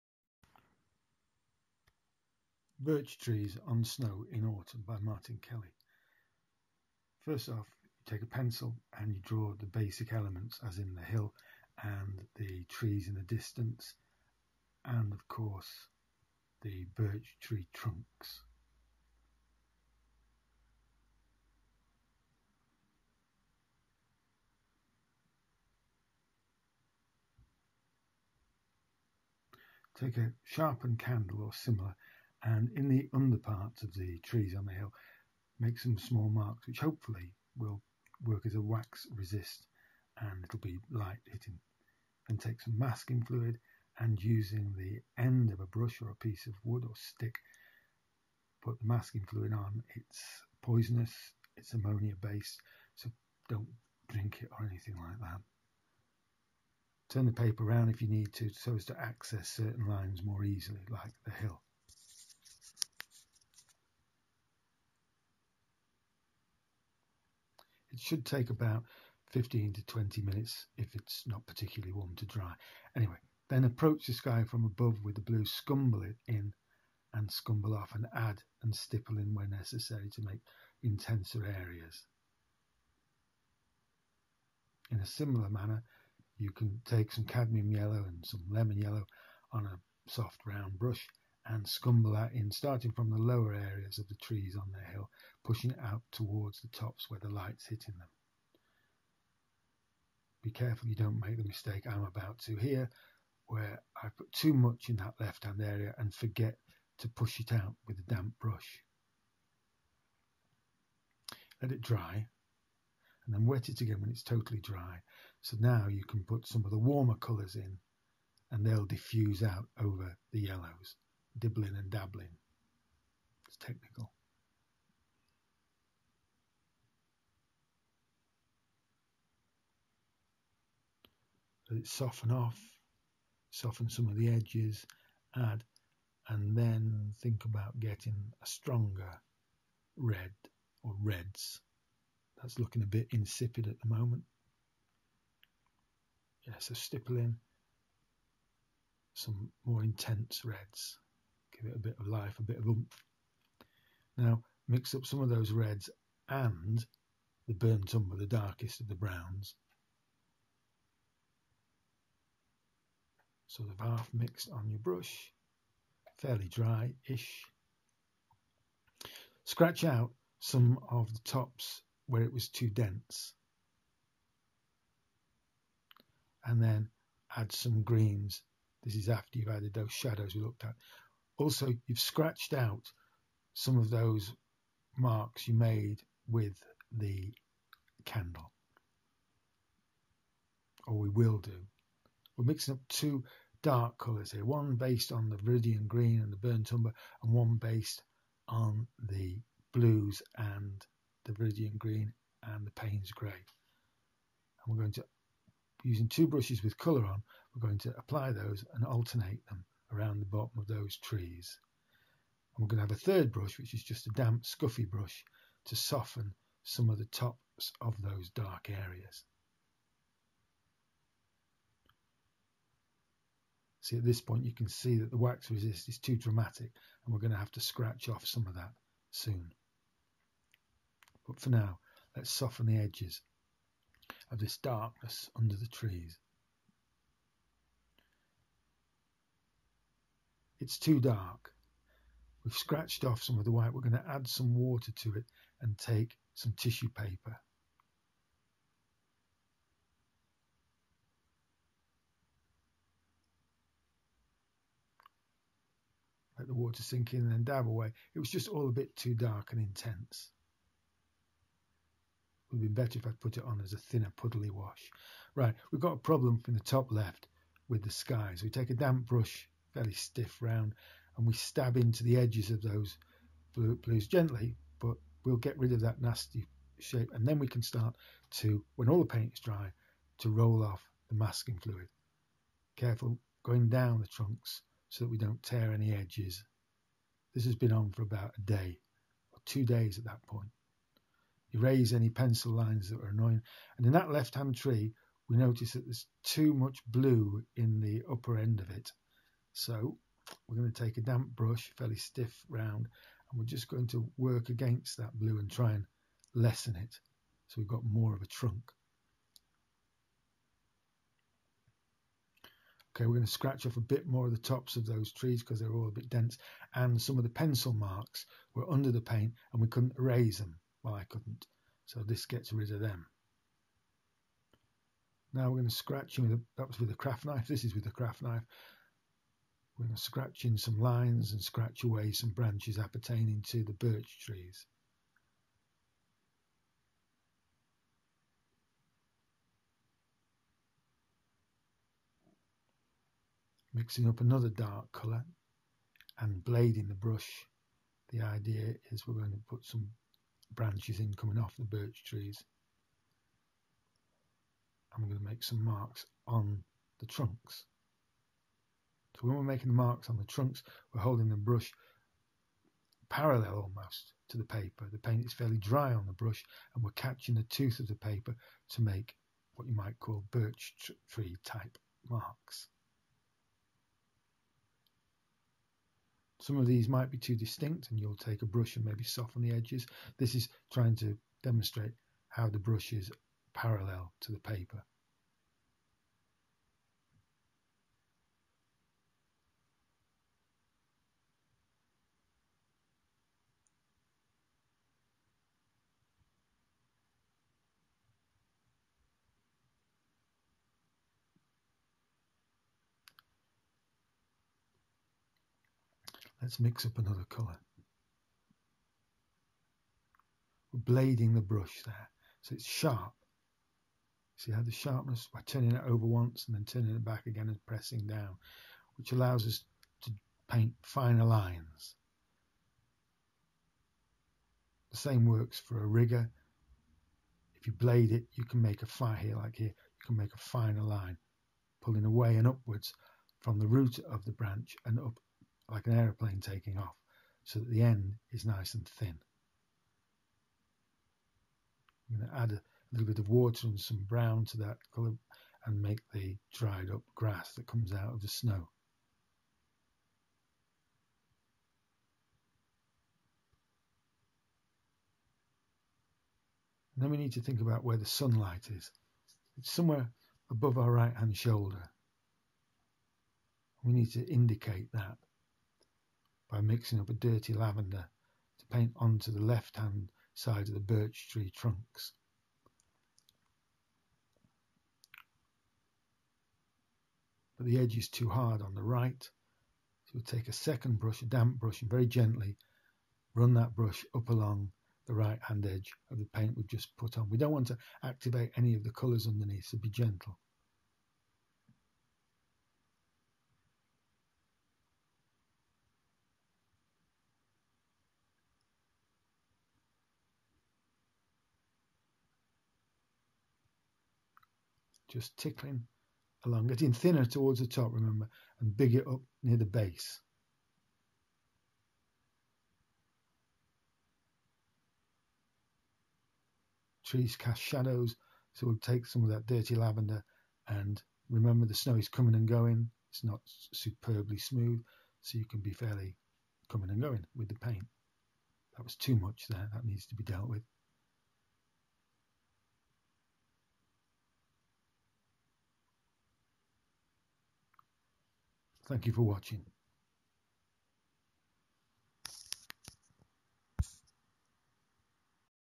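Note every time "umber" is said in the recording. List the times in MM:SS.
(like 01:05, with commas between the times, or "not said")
02:37, 03:16.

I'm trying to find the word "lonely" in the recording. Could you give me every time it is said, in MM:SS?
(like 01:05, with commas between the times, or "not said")
not said.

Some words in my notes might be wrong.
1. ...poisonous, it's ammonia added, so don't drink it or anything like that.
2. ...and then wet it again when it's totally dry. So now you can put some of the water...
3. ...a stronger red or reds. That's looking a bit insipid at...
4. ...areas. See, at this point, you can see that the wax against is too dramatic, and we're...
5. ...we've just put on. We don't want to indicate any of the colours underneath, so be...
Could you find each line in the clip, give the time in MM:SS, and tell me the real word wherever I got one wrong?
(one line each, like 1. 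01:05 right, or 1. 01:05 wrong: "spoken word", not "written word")
1. 00:50 wrong: "based", not "added"
2. 01:53 wrong: "warmer", not "water"
3. 02:18 right
4. 03:38 wrong: "resist", not "against"
5. 08:06 wrong: "activate", not "indicate".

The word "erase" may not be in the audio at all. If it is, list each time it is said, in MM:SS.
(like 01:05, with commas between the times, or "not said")
04:51, 05:19.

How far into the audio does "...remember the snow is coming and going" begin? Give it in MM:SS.
08:41.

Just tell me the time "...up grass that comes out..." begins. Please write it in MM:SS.
07:26.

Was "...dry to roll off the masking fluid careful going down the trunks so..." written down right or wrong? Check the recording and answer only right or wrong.
right.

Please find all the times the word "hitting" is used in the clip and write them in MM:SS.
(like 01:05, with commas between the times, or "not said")
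00:41, 01:37.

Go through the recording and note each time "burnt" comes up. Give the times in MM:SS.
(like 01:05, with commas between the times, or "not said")
02:37, 03:16.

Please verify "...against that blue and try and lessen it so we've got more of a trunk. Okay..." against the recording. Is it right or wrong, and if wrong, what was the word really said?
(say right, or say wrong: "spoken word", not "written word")
right.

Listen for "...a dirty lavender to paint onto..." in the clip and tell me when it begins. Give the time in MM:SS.
07:47.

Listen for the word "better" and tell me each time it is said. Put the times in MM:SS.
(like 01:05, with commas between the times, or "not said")
04:22.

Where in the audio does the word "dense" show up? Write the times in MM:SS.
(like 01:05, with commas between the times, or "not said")
02:52, 05:16.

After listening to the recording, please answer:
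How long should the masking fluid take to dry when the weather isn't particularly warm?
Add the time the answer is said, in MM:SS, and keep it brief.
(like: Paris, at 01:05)
15 to 20 minutes, at 01:09.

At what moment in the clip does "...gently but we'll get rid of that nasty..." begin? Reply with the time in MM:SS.
04:34.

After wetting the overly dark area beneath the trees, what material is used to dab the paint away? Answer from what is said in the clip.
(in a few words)
tissue paper.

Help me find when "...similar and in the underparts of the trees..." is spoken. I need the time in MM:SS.
00:31.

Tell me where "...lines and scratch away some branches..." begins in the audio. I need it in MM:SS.
05:30.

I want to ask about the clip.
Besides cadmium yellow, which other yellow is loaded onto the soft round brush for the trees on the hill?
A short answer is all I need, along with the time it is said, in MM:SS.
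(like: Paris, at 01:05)
lemon yellow, at 01:28.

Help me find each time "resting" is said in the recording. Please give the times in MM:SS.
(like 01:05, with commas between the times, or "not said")
not said.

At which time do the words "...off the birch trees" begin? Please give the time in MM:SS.
05:51.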